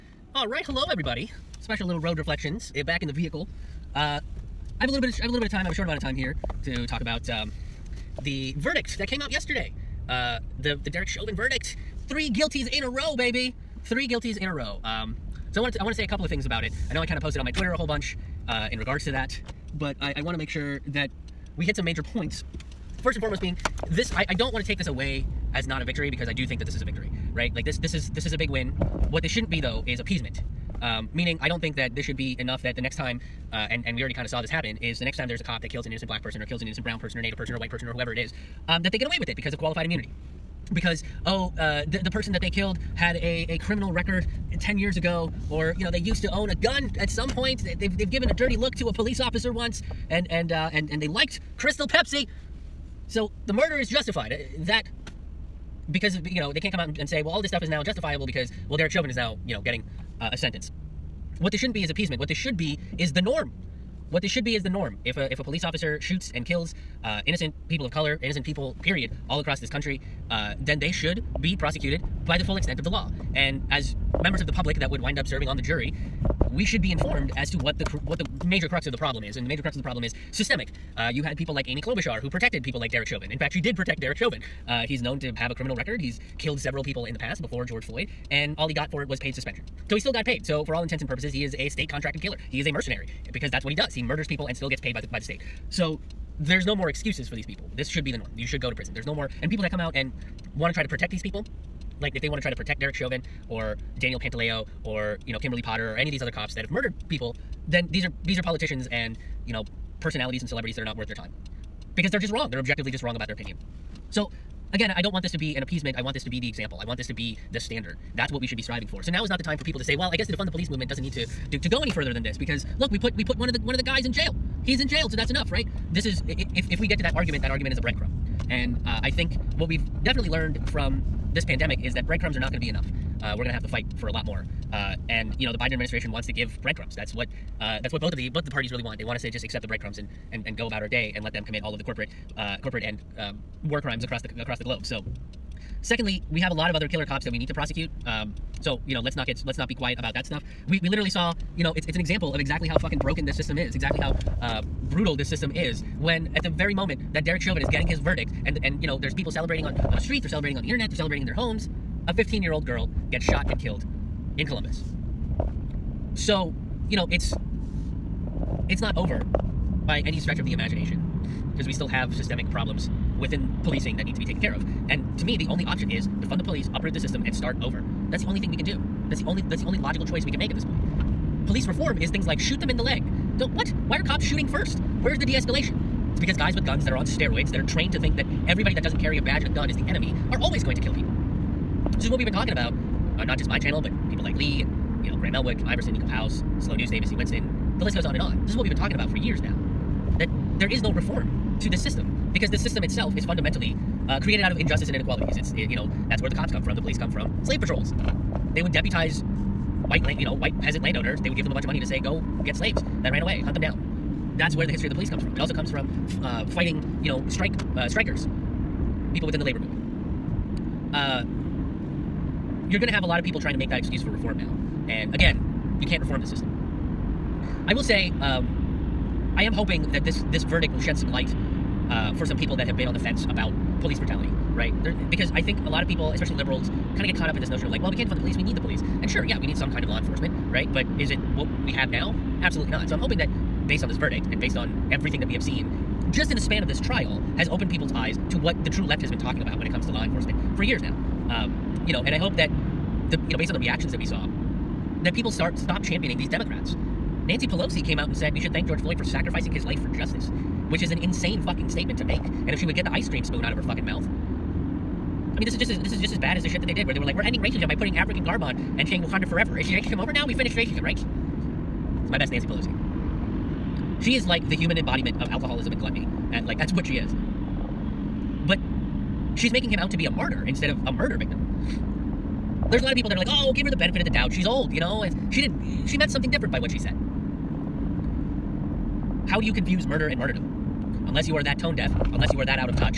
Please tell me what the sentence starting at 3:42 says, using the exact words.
you're going to have a lot of people trying to make that excuse for reform now.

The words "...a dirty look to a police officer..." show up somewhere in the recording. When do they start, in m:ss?
0:48.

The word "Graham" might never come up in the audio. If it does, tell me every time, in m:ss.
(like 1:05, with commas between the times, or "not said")
3:15.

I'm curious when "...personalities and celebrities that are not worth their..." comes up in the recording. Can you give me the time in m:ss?
1:50.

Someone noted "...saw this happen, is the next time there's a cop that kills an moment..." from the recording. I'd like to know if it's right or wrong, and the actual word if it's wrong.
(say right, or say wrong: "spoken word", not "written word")
wrong: "innocent", not "moment".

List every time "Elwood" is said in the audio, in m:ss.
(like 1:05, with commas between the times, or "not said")
3:15.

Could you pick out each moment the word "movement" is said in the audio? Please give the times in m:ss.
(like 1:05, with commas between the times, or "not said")
2:00, 3:39.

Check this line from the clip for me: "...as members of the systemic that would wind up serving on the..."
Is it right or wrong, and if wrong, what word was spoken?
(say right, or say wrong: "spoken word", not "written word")
wrong: "public", not "systemic".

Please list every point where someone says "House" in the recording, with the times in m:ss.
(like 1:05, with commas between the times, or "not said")
3:16.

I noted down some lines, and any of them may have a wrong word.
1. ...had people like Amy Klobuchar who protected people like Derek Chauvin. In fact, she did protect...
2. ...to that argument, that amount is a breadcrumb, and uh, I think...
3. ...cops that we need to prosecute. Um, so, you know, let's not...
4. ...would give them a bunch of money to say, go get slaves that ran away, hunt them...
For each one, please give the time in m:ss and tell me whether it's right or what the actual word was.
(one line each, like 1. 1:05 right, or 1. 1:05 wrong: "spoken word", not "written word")
1. 1:21 right
2. 2:06 wrong: "argument", not "amount"
3. 2:27 right
4. 3:31 right.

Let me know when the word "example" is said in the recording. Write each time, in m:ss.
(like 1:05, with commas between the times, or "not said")
1:56, 2:31.